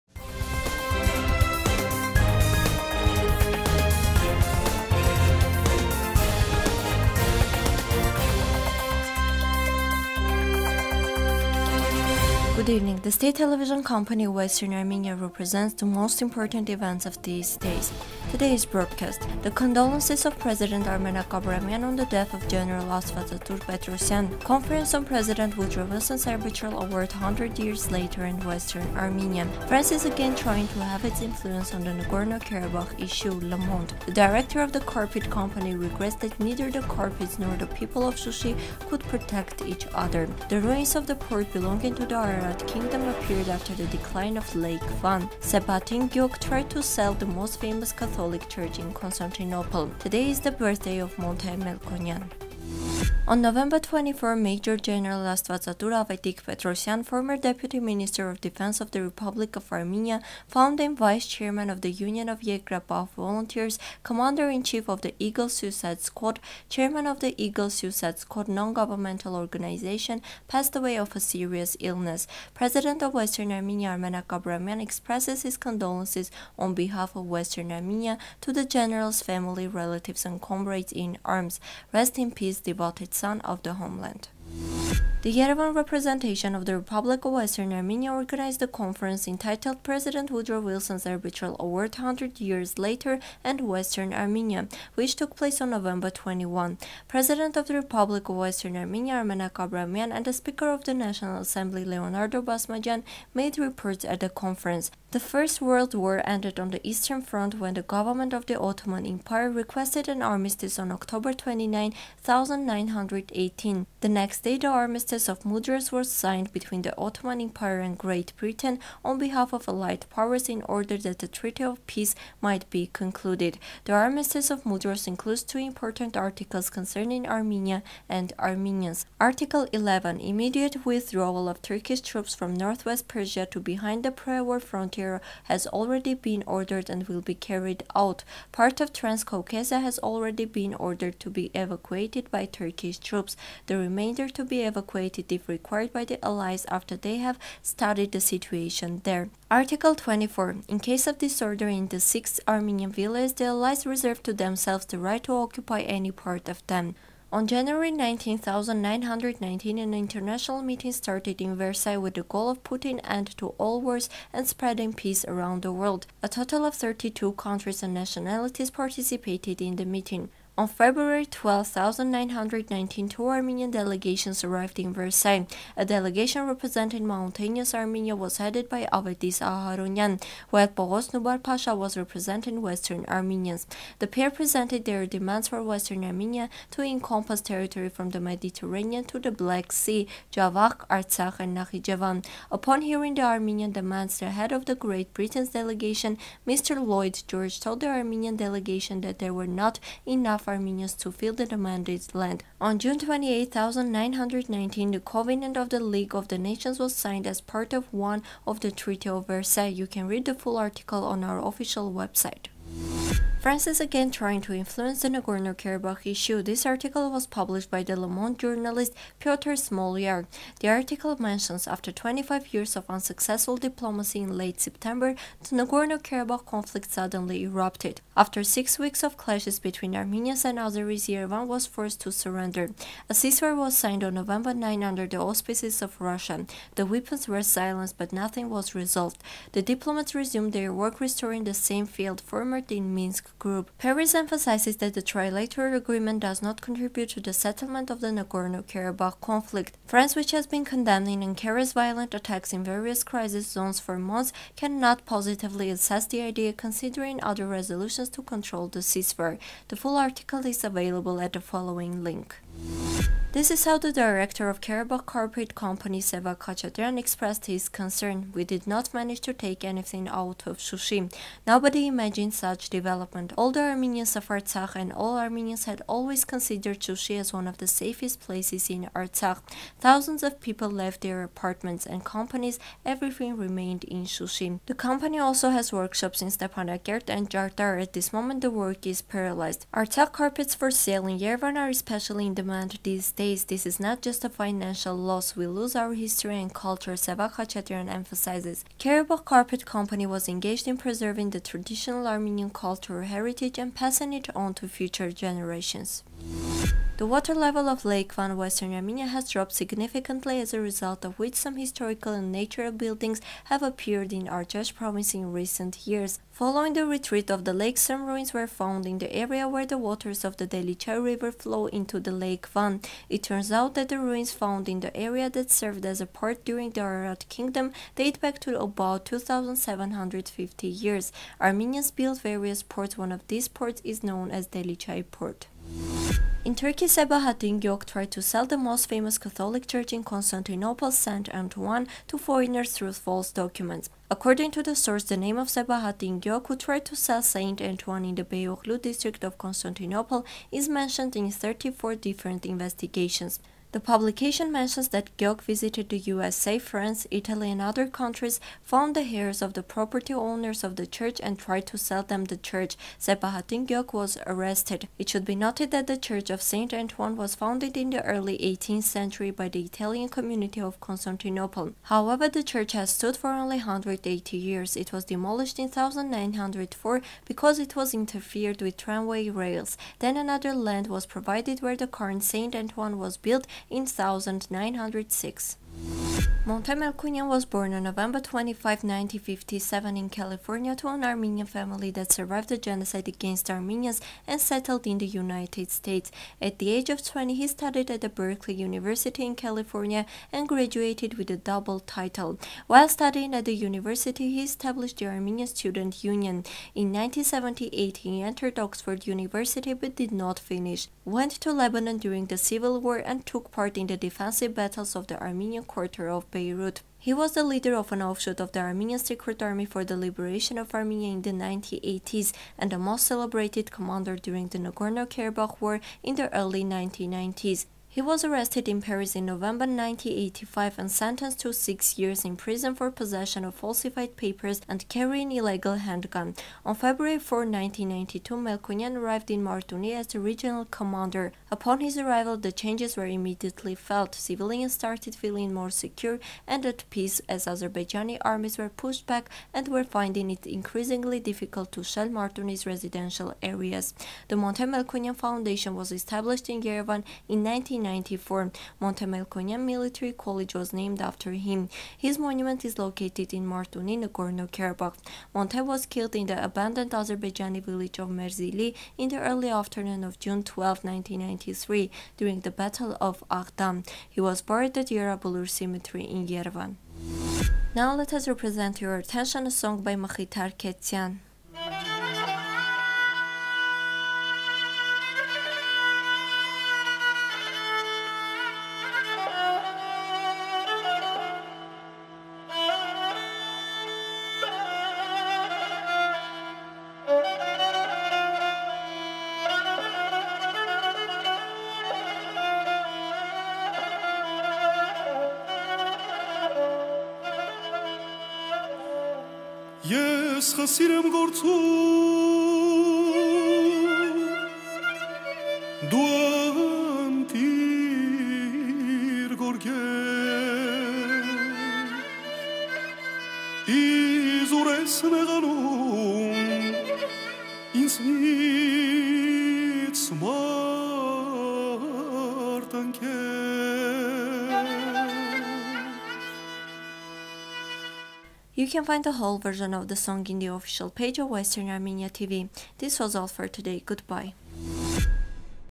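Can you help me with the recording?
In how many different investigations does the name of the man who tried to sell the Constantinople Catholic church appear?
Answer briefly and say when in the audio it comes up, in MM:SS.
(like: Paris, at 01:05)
34, at 05:51.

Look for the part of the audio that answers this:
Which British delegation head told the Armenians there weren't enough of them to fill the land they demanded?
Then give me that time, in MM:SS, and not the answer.
03:16.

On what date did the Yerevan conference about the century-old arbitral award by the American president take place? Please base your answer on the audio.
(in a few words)
November 21.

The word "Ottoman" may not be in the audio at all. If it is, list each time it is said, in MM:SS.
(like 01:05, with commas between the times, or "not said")
01:48, 01:56.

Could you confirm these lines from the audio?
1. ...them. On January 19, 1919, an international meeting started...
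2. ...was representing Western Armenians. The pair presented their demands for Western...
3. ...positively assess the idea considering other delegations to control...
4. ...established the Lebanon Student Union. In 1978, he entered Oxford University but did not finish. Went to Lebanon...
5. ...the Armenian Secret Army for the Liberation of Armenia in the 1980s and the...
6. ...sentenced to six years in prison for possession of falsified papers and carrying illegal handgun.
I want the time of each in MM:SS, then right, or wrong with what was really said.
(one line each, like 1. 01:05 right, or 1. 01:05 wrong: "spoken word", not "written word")
1. 02:36 right
2. 03:01 right
3. 04:15 wrong: "resolutions", not "delegations"
4. 06:44 wrong: "Armenian", not "Lebanon"
5. 06:58 right
6. 07:10 right.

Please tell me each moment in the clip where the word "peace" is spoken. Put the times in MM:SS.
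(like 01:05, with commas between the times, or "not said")
01:22, 02:01, 02:44, 07:26.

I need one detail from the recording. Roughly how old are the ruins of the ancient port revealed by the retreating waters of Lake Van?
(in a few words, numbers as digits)
2750 years.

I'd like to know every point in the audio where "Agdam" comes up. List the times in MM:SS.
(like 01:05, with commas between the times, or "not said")
07:53.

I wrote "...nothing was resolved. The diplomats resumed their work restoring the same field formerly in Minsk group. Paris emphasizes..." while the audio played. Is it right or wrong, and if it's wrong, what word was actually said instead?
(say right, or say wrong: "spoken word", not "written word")
right.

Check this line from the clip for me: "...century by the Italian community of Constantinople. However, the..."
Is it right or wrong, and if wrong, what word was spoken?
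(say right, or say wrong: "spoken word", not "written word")
right.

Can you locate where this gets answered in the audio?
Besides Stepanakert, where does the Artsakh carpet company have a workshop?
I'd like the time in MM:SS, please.
04:47.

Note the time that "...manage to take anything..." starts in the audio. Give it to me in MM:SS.
04:28.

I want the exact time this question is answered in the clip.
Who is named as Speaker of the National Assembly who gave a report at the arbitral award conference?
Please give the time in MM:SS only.
01:41.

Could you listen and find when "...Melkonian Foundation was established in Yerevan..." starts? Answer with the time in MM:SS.
07:34.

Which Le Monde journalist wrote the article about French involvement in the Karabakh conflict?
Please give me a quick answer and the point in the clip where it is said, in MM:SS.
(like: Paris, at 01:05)
Piotr Smolar, at 03:39.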